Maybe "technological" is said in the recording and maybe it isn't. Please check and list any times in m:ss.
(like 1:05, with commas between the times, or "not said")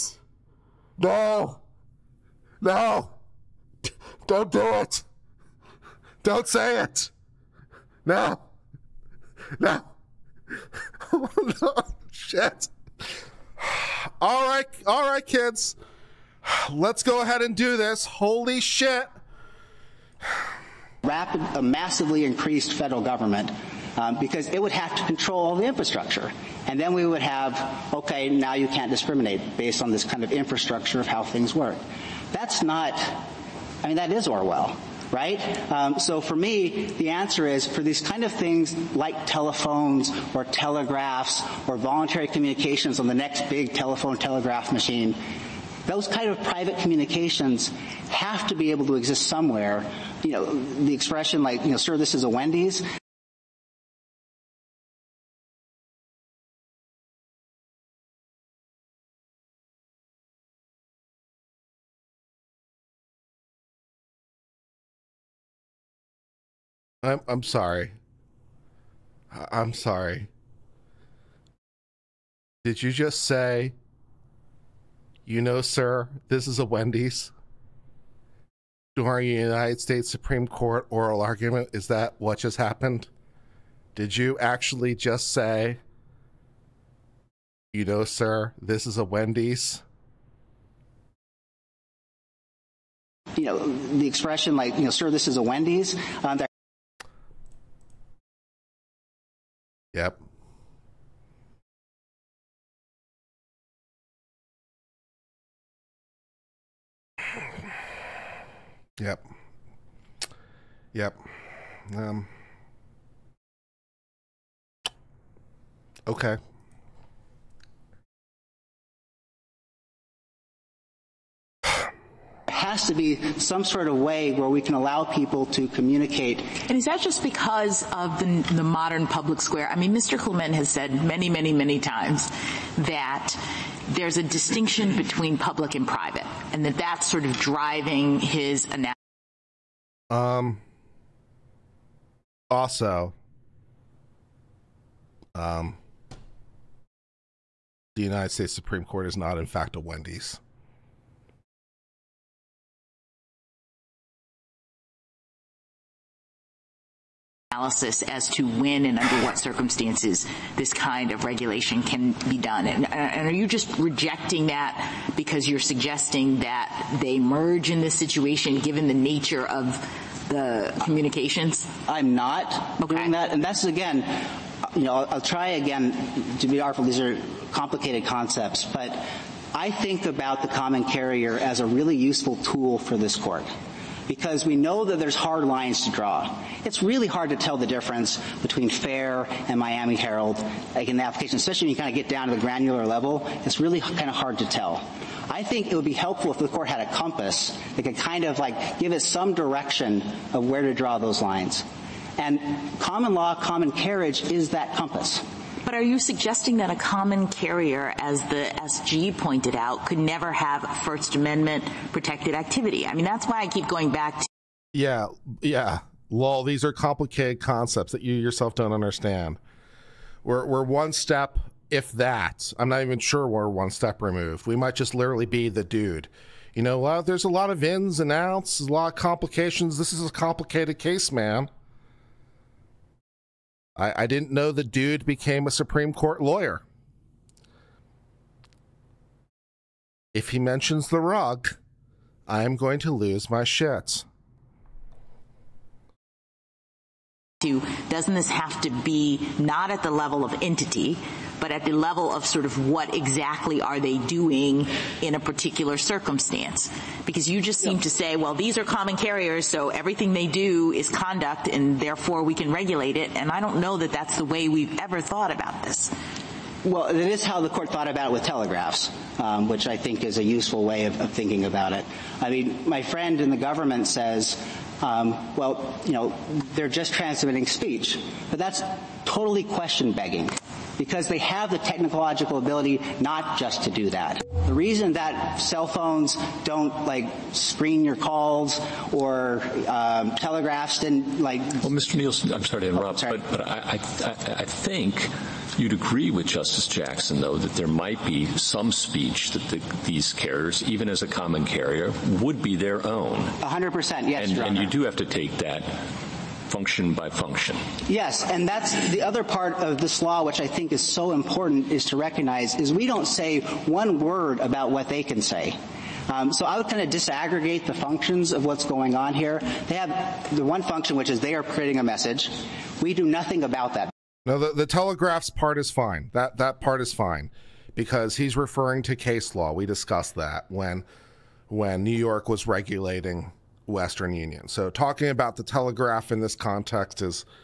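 4:41.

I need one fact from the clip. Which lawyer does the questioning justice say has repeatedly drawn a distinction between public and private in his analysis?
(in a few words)
Mr. Clement.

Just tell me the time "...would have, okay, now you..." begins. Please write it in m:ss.
0:27.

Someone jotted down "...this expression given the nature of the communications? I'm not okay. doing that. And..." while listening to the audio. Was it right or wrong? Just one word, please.
wrong.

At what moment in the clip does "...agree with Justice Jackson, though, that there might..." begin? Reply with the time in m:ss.
4:55.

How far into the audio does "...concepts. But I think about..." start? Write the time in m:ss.
2:58.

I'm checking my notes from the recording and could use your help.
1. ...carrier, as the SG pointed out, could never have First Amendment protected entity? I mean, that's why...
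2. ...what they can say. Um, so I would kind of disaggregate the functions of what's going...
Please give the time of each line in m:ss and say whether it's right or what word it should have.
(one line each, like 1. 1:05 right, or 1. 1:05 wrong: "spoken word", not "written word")
1. 3:27 wrong: "activity", not "entity"
2. 5:14 right.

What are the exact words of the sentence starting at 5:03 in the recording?
100 percent, yes, and, and you do have to take that function by function.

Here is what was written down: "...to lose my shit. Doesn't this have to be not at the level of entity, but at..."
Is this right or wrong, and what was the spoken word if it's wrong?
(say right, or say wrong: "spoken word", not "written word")
right.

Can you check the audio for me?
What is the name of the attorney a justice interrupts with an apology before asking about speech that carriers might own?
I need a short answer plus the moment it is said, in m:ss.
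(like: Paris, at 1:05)
Mr. Nielson, at 4:51.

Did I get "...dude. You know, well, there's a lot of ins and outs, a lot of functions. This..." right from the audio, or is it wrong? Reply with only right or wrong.
wrong.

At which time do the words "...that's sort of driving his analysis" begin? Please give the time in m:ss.
2:16.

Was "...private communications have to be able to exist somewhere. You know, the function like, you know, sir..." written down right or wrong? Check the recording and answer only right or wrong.
wrong.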